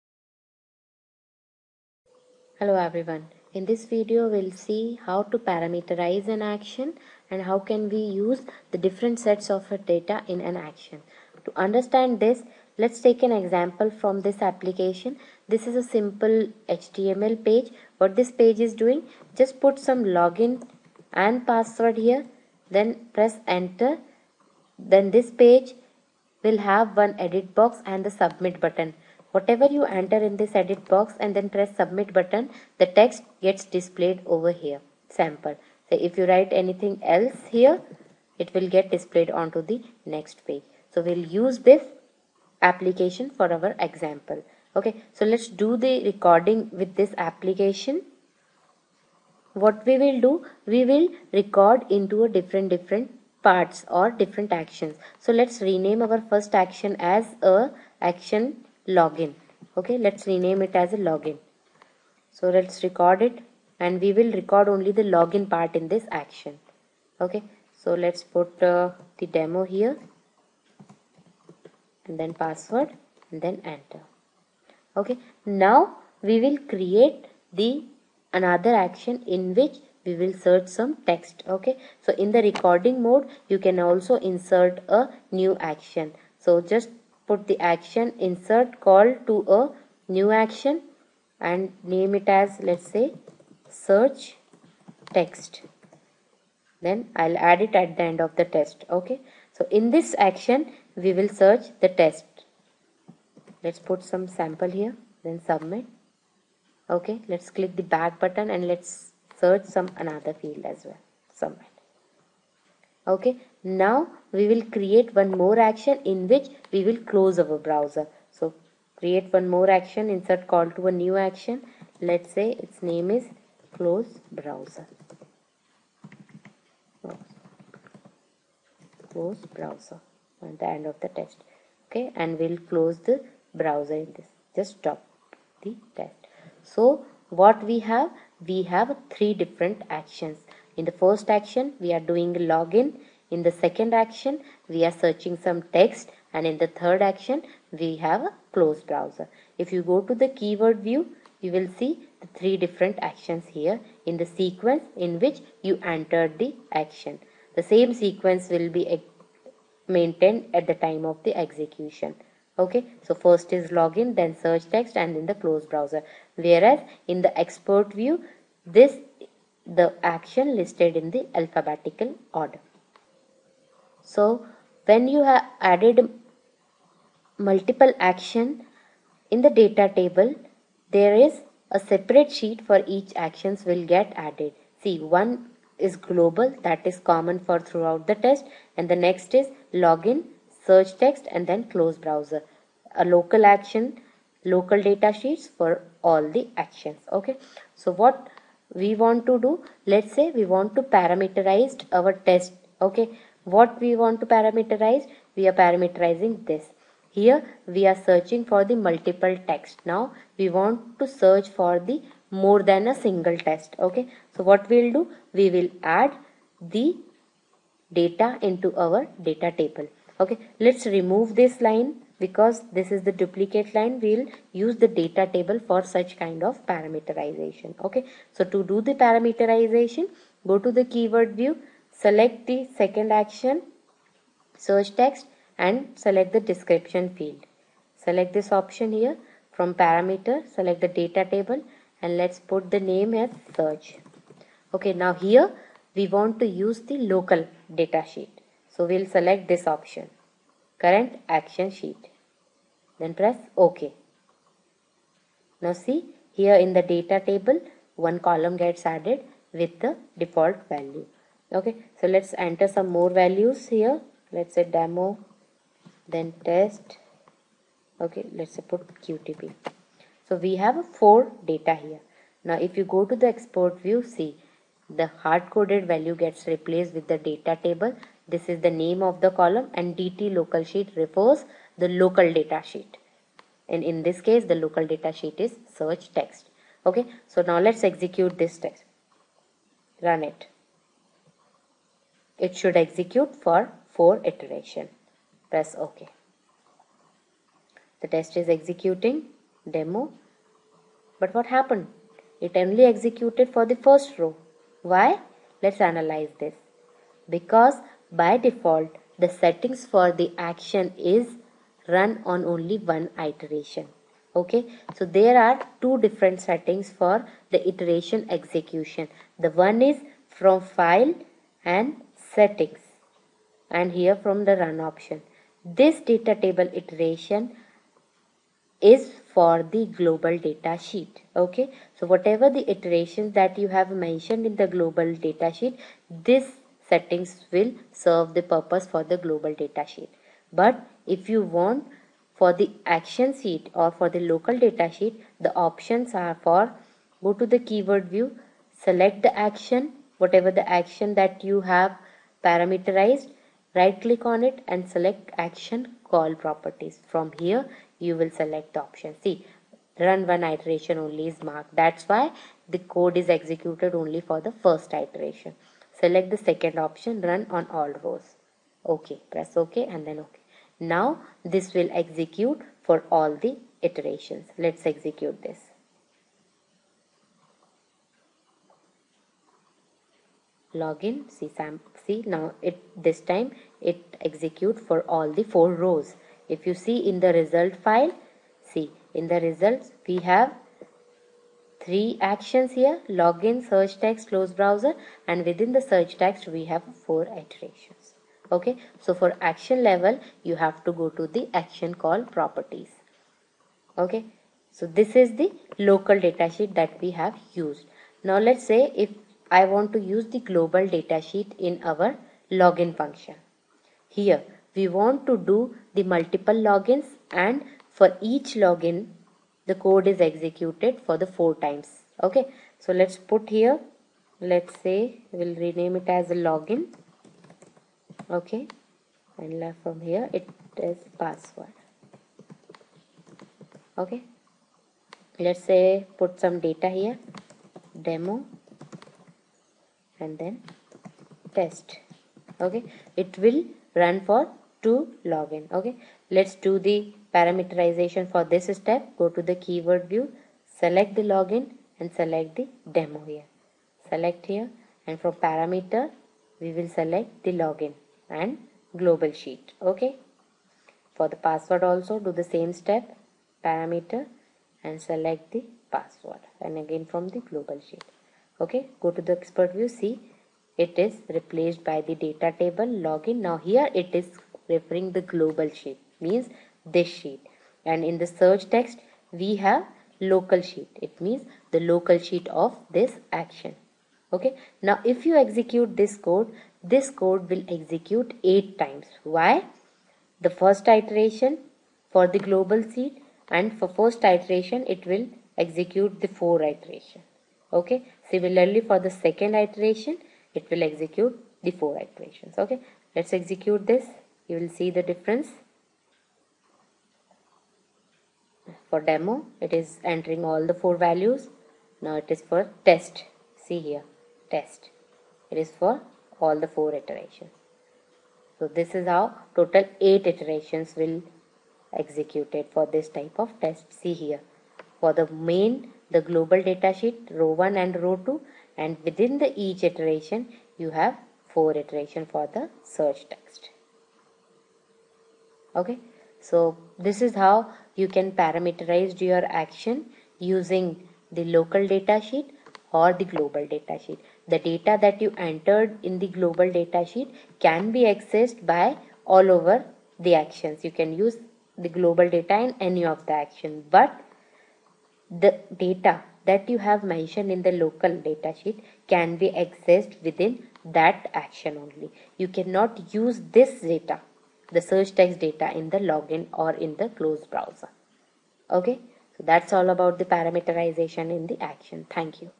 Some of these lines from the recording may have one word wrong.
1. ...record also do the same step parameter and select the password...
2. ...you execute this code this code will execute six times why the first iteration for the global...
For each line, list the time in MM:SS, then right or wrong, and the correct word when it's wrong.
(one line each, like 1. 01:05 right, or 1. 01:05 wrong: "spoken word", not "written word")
1. 07:41 wrong: "password", not "record"
2. 08:05 wrong: "eight", not "six".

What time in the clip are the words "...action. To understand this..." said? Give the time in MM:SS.
00:10.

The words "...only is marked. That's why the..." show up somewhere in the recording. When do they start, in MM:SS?
06:00.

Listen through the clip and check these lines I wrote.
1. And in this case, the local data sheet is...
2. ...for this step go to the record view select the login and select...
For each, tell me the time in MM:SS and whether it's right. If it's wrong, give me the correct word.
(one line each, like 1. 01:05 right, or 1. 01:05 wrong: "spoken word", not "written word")
1. 04:43 right
2. 07:28 wrong: "keyword", not "record".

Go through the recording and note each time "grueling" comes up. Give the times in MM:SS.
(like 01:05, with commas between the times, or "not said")
not said.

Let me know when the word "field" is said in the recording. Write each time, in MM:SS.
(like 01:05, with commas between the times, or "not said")
01:50, 03:57.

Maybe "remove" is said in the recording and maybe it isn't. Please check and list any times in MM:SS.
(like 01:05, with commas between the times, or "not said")
03:40.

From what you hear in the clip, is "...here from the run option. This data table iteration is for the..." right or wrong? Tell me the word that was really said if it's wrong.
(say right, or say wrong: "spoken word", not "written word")
right.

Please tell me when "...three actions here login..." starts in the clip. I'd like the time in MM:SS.
06:31.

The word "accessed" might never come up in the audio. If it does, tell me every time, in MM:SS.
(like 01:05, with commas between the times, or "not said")
09:08, 09:19.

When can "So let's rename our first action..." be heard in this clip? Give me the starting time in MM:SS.
00:55.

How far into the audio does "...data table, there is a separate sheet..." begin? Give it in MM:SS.
02:59.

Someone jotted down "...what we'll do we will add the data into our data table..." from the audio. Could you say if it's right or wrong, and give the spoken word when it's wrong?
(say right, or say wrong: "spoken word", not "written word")
right.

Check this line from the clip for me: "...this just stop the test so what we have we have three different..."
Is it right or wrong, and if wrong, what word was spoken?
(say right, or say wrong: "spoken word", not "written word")
right.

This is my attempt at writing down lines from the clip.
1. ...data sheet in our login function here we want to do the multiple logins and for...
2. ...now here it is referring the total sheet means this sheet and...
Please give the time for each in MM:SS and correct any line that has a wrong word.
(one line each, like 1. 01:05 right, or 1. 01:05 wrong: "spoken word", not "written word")
1. 06:50 right
2. 07:53 wrong: "global", not "total".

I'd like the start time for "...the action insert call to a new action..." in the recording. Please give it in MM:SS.
01:27.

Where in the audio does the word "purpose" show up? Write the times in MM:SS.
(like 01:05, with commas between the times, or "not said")
05:38.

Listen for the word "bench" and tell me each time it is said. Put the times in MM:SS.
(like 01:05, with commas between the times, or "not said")
not said.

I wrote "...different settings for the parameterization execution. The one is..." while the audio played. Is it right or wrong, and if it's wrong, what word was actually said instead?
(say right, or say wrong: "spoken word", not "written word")
wrong: "iteration", not "parameterization".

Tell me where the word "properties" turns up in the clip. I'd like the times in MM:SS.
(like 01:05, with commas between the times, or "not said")
05:56, 06:42.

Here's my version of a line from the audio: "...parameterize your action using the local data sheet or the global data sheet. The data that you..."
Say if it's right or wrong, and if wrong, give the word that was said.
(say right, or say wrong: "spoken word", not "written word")
right.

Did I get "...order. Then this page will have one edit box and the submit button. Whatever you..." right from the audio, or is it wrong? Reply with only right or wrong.
wrong.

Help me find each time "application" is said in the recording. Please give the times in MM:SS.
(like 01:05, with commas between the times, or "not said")
00:14, 00:42, 00:47.